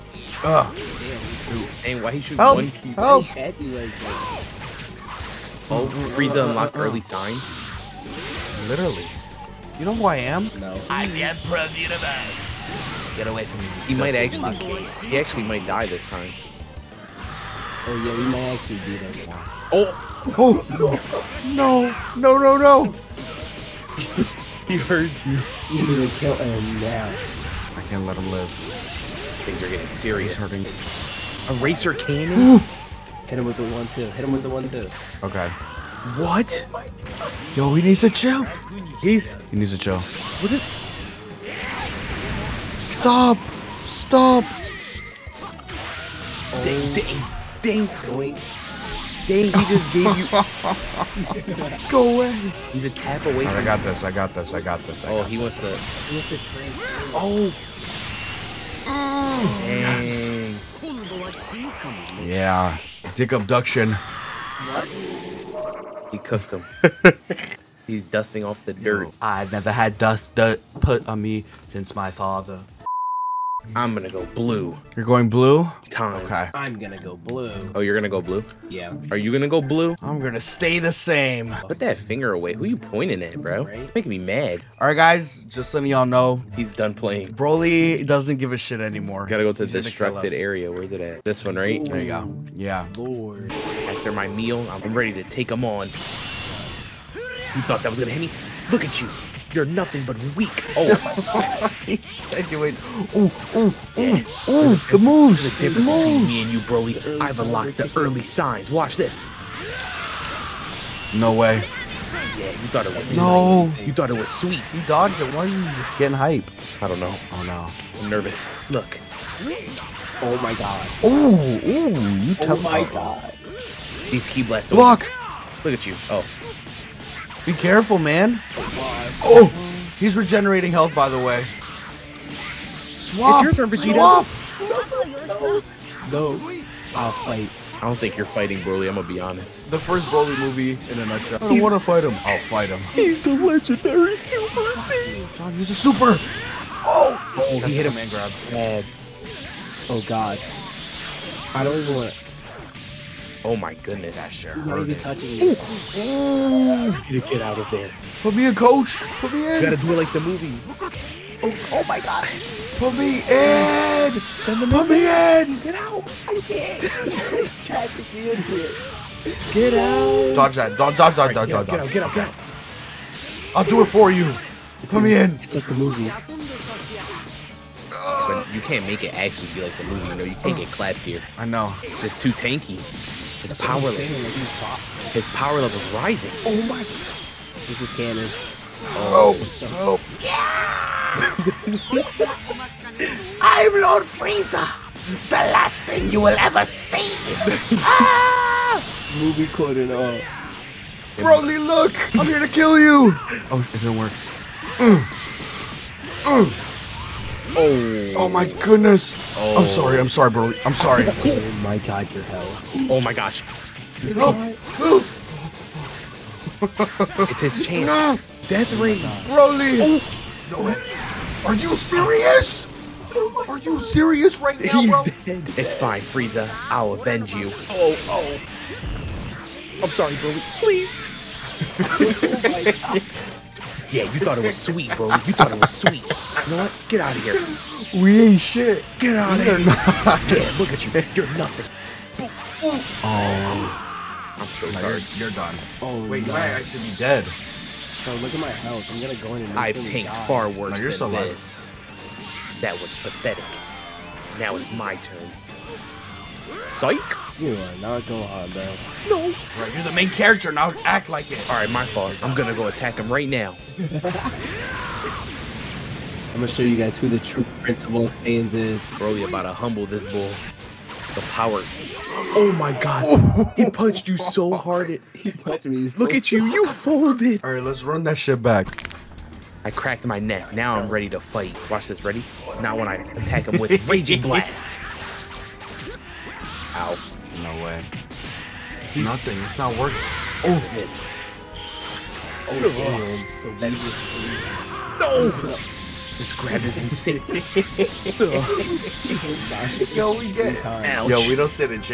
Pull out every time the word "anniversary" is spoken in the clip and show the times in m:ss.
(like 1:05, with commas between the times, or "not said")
not said.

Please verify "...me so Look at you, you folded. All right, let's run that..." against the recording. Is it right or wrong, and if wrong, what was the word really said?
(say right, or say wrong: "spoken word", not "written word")
right.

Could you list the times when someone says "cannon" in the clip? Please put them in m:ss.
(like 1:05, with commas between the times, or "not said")
0:31, 3:07.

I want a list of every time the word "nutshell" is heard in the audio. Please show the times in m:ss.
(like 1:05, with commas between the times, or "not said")
2:21.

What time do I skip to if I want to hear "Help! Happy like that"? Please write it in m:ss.
0:02.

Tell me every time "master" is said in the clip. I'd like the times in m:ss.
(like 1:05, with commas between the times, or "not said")
not said.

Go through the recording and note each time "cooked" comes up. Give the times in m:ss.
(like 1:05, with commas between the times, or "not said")
1:06.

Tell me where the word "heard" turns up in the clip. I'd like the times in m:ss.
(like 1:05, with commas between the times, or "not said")
0:24.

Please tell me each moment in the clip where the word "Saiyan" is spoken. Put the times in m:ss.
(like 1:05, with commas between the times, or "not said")
2:24, 4:28.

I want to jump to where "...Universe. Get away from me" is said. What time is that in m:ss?
0:11.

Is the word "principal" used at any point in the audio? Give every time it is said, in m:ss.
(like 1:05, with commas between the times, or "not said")
4:27.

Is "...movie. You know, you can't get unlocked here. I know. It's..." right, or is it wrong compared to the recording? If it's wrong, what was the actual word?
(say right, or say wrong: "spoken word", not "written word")
wrong: "clapped", not "unlocked".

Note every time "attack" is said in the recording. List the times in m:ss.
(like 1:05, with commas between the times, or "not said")
4:22, 4:42.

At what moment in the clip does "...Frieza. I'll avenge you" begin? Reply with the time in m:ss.
3:46.